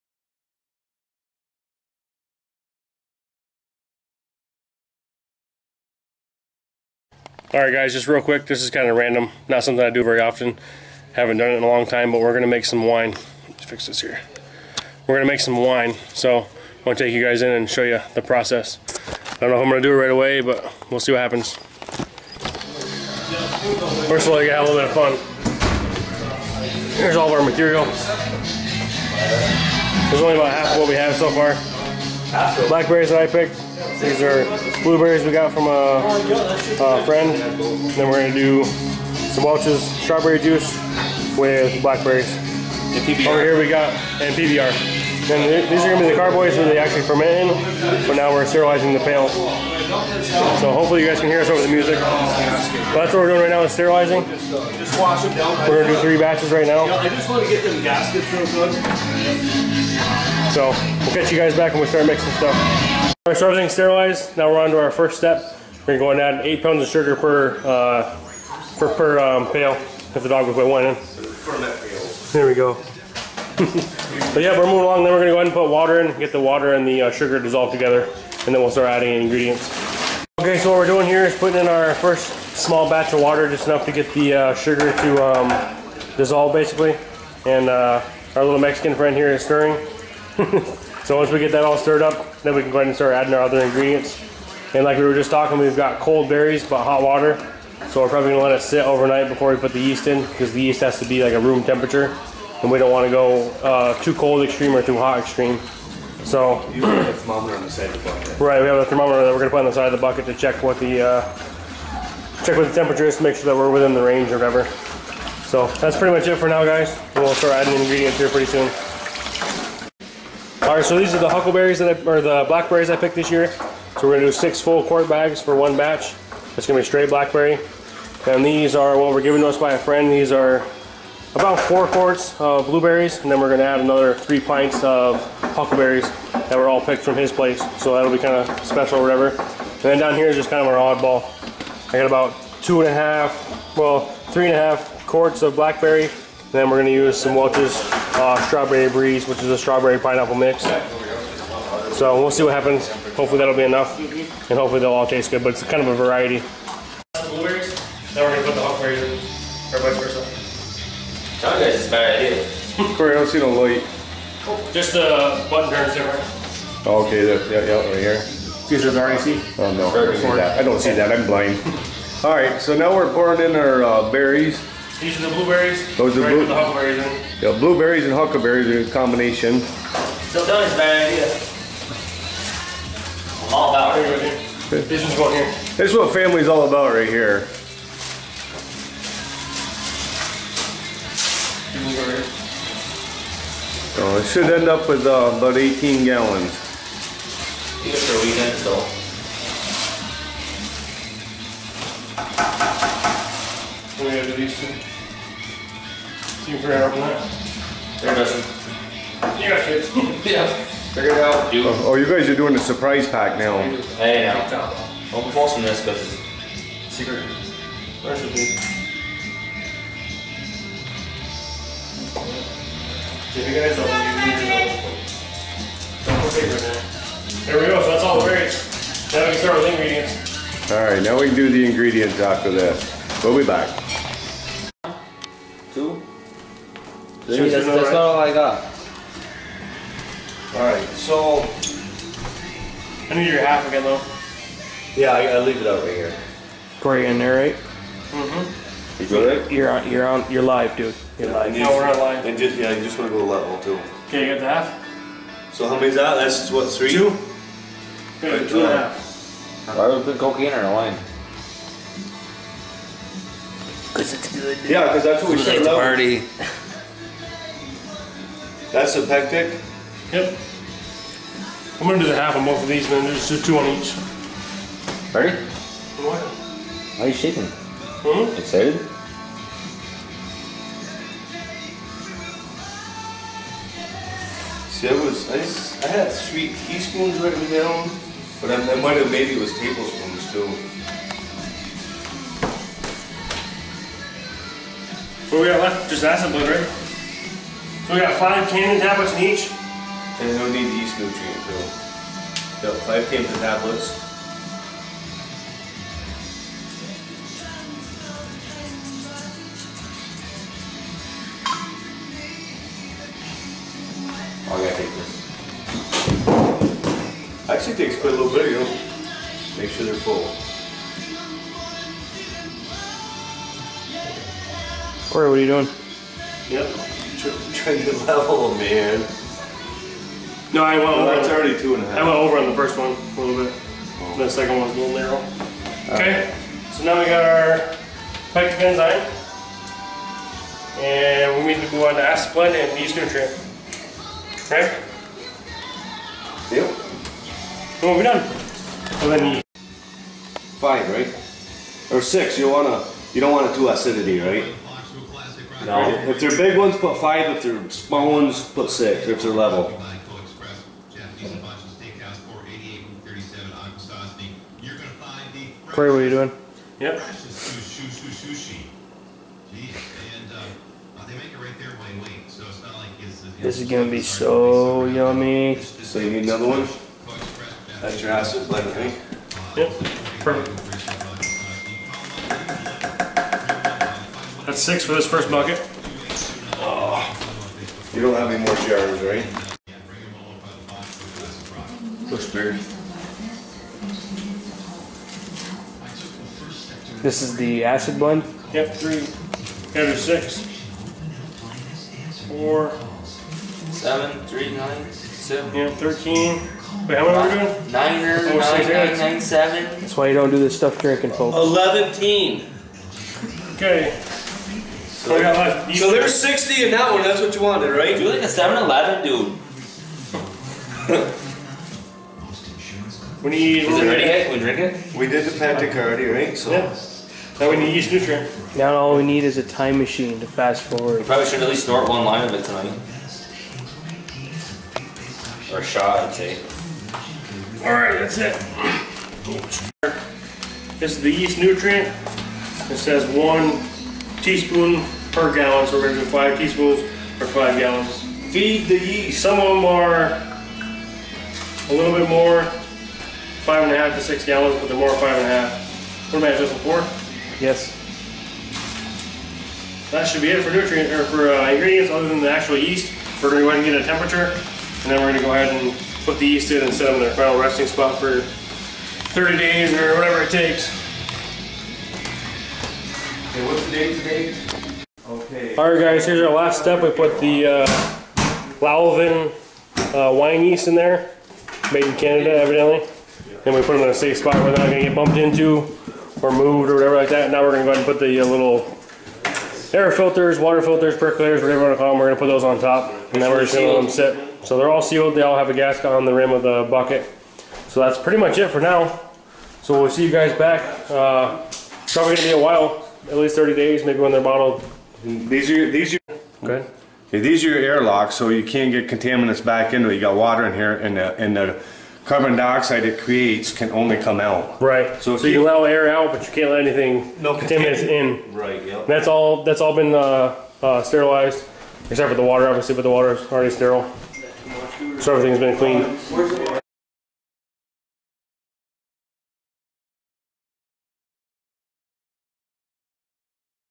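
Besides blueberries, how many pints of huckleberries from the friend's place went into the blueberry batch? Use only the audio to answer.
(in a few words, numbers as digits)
3 pints.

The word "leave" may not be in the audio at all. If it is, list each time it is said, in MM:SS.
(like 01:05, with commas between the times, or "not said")
04:05.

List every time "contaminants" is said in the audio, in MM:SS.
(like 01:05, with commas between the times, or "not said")
08:28, 08:37.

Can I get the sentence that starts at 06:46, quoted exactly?
Wait, how many are we doing?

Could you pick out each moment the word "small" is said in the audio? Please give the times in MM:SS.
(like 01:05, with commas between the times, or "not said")
01:22, 05:57.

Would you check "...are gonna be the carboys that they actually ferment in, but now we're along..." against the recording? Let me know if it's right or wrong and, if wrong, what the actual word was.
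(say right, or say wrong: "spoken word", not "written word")
wrong: "sterilizing", not "along".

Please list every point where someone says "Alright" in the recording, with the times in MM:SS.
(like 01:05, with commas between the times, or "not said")
00:07, 03:50, 04:00, 07:17, 07:55.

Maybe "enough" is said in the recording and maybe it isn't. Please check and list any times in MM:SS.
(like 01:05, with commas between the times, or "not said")
01:23, 02:33.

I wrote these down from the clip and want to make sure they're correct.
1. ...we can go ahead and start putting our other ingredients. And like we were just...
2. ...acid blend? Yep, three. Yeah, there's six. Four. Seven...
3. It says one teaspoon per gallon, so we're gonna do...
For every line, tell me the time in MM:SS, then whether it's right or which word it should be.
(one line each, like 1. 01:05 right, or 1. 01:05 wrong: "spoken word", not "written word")
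1. 01:32 wrong: "adding", not "putting"
2. 06:37 right
3. 07:22 right.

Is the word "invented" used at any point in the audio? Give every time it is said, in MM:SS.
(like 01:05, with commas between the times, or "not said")
not said.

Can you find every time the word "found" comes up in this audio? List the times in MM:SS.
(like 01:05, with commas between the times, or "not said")
not said.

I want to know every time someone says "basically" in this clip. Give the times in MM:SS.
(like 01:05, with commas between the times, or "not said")
01:26.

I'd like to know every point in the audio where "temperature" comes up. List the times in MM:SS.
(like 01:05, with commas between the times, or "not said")
01:41, 01:52, 07:43.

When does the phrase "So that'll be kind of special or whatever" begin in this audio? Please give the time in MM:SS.
02:17.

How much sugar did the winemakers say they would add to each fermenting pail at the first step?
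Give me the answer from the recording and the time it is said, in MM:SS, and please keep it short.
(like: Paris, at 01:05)
8 pounds, at 01:06.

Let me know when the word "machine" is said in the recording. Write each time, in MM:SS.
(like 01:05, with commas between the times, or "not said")
07:09.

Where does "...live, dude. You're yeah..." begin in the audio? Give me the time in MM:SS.
04:10.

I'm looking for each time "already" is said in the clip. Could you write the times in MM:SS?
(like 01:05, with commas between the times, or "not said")
05:31, 07:05, 08:43.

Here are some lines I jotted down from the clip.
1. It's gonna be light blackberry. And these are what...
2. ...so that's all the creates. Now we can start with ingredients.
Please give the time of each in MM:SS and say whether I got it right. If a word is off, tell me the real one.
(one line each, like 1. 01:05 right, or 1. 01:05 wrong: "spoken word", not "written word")
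1. 02:06 wrong: "straight", not "light"
2. 03:47 wrong: "berries", not "creates".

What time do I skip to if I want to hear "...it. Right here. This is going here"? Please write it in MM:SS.
03:03.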